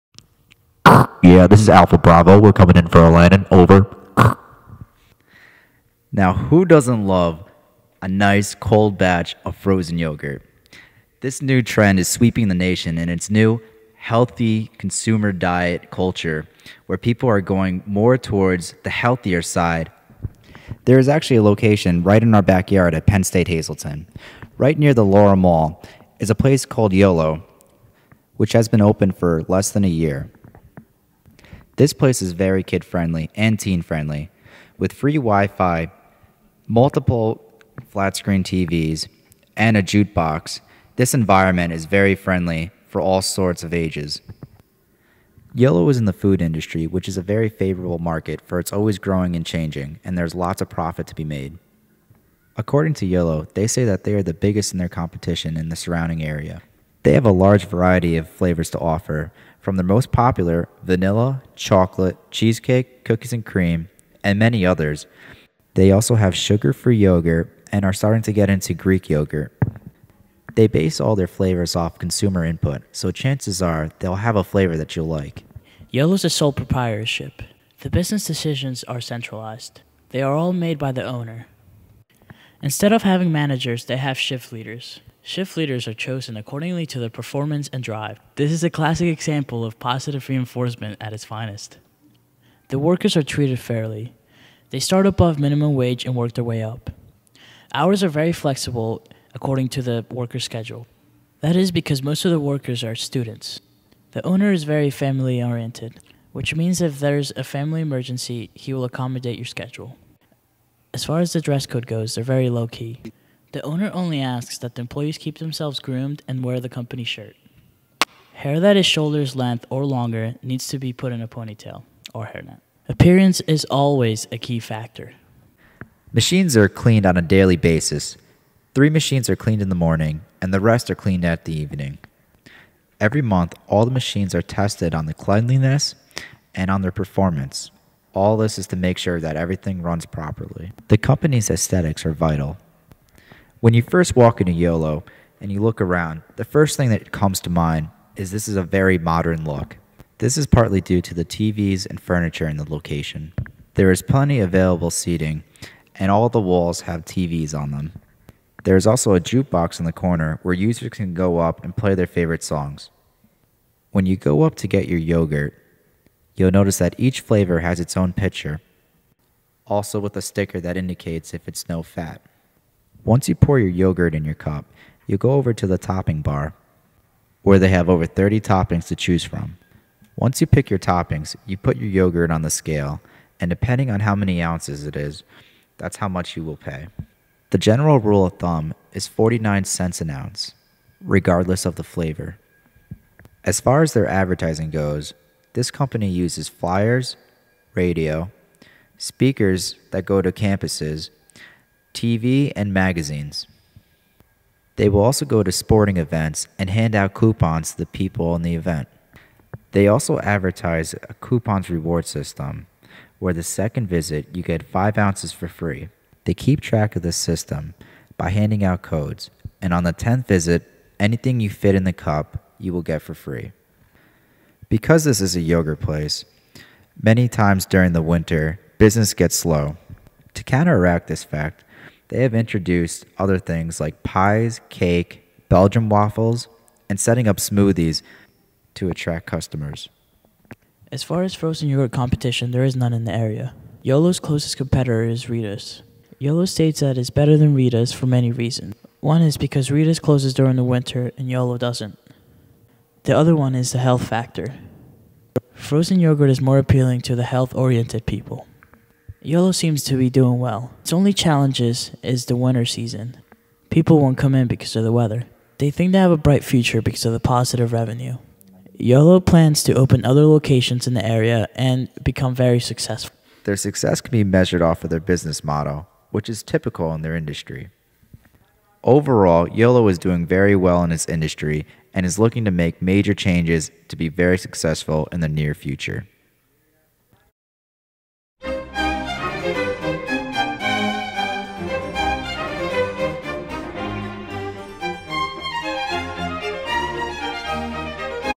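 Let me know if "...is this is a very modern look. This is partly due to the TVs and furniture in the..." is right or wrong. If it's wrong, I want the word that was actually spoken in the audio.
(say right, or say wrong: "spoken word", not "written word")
right.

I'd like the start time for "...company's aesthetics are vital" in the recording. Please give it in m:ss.
2:20.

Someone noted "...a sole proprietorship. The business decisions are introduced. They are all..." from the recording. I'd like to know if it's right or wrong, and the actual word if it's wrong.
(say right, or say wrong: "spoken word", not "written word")
wrong: "centralized", not "introduced".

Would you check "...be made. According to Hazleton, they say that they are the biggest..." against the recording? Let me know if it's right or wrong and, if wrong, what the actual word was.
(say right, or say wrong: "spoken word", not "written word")
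wrong: "Yolo", not "Hazleton".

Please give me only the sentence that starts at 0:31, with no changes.
This place is very kid friendly and teen friendly with free Wi Fi, multiple flat screen TVs, and a jukebox.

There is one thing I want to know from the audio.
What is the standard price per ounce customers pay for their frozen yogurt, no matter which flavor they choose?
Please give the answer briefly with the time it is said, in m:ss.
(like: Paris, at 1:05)
49 cents, at 3:09.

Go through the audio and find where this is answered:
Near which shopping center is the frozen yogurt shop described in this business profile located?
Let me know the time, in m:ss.
0:25.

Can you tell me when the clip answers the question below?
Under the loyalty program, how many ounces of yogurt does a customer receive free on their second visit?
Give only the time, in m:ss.
3:34.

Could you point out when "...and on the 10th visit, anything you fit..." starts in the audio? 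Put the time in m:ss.
3:39.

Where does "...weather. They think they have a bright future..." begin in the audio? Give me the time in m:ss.
4:24.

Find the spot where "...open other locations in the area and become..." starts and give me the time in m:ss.
4:29.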